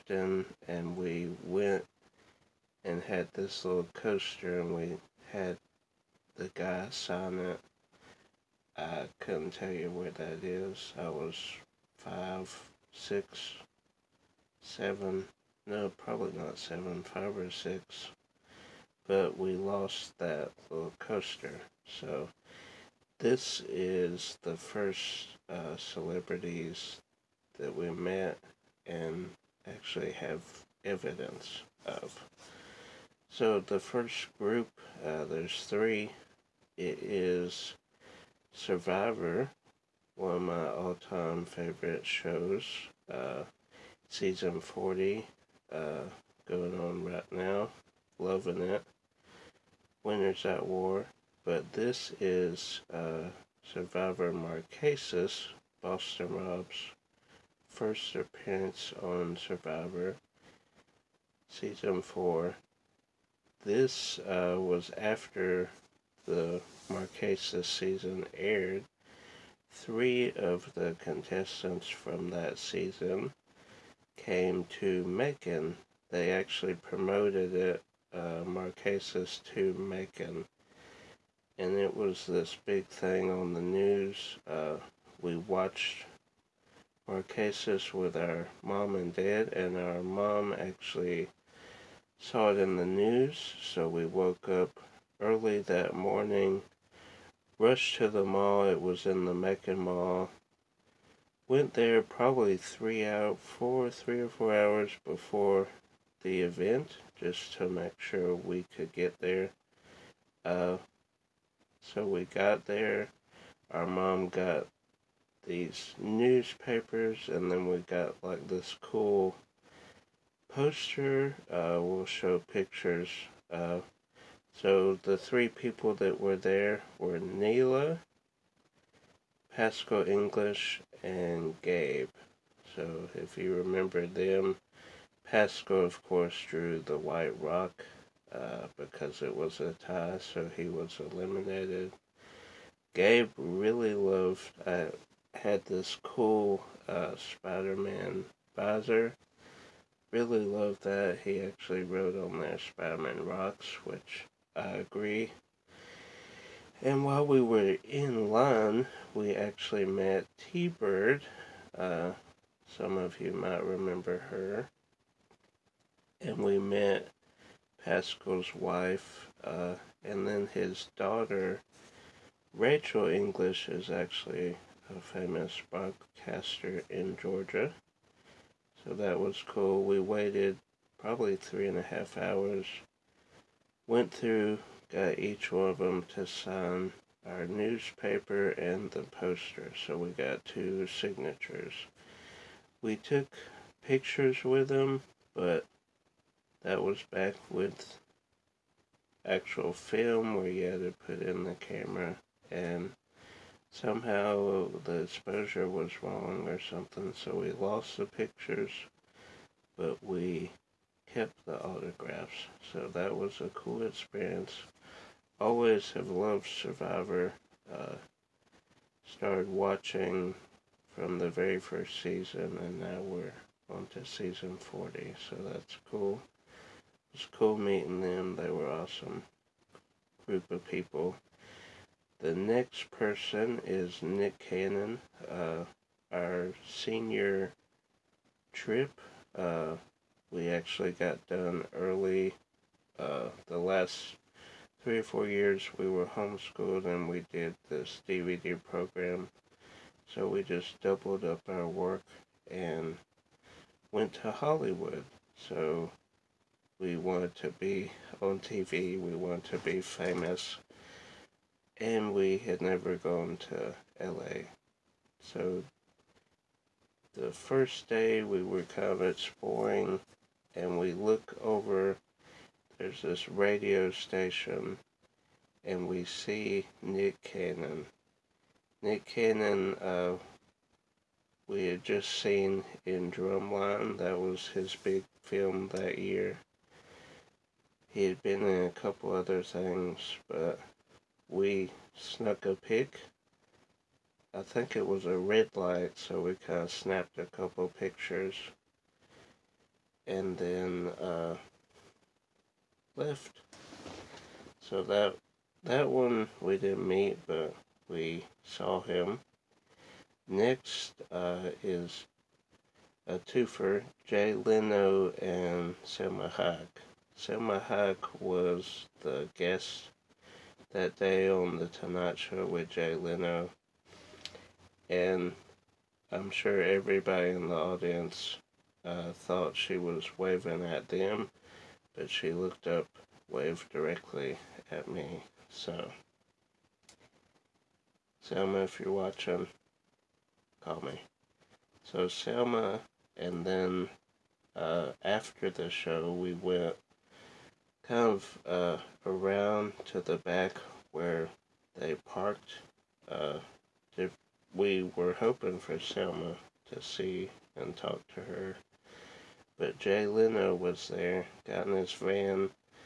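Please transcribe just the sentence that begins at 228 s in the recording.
They were awesome group of people.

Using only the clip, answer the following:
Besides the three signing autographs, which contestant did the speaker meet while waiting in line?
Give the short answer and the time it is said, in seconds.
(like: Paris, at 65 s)
T Bird, at 160 s.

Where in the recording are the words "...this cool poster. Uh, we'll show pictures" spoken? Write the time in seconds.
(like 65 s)
118 s.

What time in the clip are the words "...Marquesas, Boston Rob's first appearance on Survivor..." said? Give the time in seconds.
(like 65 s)
54 s.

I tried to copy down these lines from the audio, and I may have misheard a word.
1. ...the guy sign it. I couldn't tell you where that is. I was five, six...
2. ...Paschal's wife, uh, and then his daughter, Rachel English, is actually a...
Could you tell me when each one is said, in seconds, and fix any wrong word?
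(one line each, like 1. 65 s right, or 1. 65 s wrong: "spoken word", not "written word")
1. 6 s right
2. 167 s right.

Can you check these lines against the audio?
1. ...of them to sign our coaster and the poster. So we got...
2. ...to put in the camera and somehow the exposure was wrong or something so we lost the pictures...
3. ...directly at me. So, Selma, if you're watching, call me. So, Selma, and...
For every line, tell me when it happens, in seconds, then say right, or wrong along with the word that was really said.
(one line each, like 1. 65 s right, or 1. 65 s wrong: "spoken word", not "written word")
1. 185 s wrong: "newspaper", not "coaster"
2. 200 s right
3. 333 s right.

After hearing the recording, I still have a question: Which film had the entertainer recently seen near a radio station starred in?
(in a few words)
Drumline.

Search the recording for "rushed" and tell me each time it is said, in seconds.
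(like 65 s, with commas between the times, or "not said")
97 s.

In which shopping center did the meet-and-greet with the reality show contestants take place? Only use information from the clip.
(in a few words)
Macon Mall.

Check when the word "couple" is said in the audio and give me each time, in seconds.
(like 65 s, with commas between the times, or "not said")
288 s, 297 s.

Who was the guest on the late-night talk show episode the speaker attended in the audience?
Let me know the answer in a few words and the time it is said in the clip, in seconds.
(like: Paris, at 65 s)
Selma Hayek, at 315 s.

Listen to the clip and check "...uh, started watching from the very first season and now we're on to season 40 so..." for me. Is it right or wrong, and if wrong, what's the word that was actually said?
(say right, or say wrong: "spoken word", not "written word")
right.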